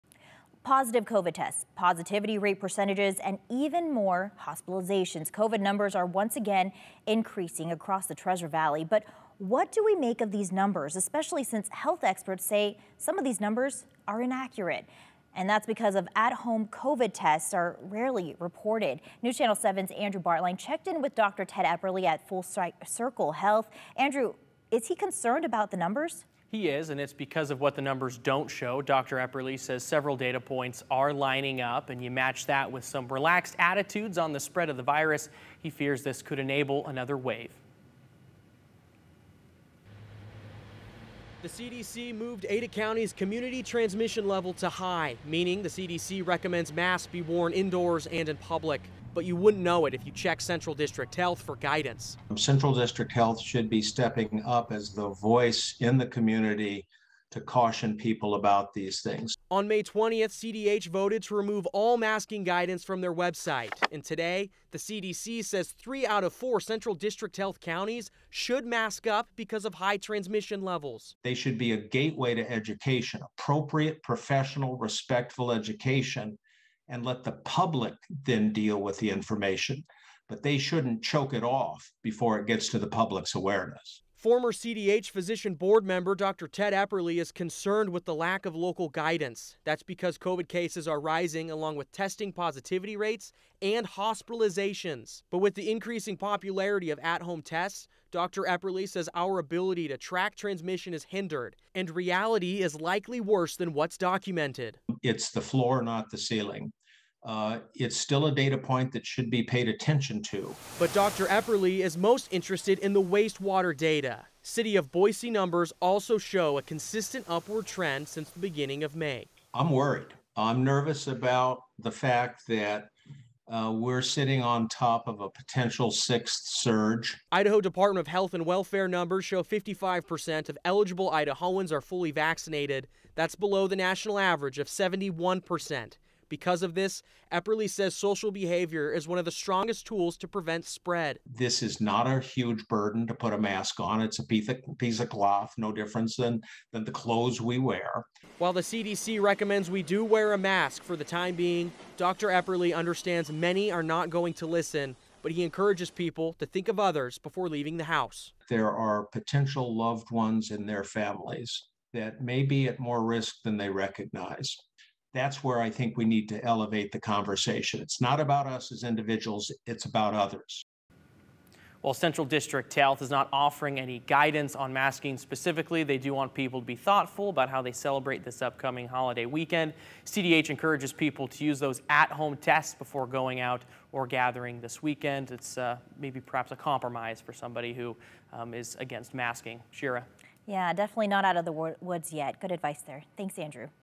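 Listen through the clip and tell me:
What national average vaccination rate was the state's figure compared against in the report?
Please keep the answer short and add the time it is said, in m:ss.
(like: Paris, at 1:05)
71%, at 2:14.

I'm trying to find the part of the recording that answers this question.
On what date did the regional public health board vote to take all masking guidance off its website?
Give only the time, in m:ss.
0:59.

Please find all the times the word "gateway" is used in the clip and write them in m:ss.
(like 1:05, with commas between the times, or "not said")
1:11.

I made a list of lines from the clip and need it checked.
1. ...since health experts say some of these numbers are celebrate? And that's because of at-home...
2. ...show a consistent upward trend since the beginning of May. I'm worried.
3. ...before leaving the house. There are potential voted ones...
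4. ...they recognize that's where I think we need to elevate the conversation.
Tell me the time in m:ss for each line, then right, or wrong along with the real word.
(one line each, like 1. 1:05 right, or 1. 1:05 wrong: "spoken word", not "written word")
1. 0:11 wrong: "inaccurate", not "celebrate"
2. 1:56 right
3. 2:37 wrong: "loved", not "voted"
4. 2:43 right.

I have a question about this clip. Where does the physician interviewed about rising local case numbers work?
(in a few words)
Full Circle Health.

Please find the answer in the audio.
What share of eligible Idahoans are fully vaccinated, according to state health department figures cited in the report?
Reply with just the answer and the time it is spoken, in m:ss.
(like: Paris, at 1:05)
55%, at 2:09.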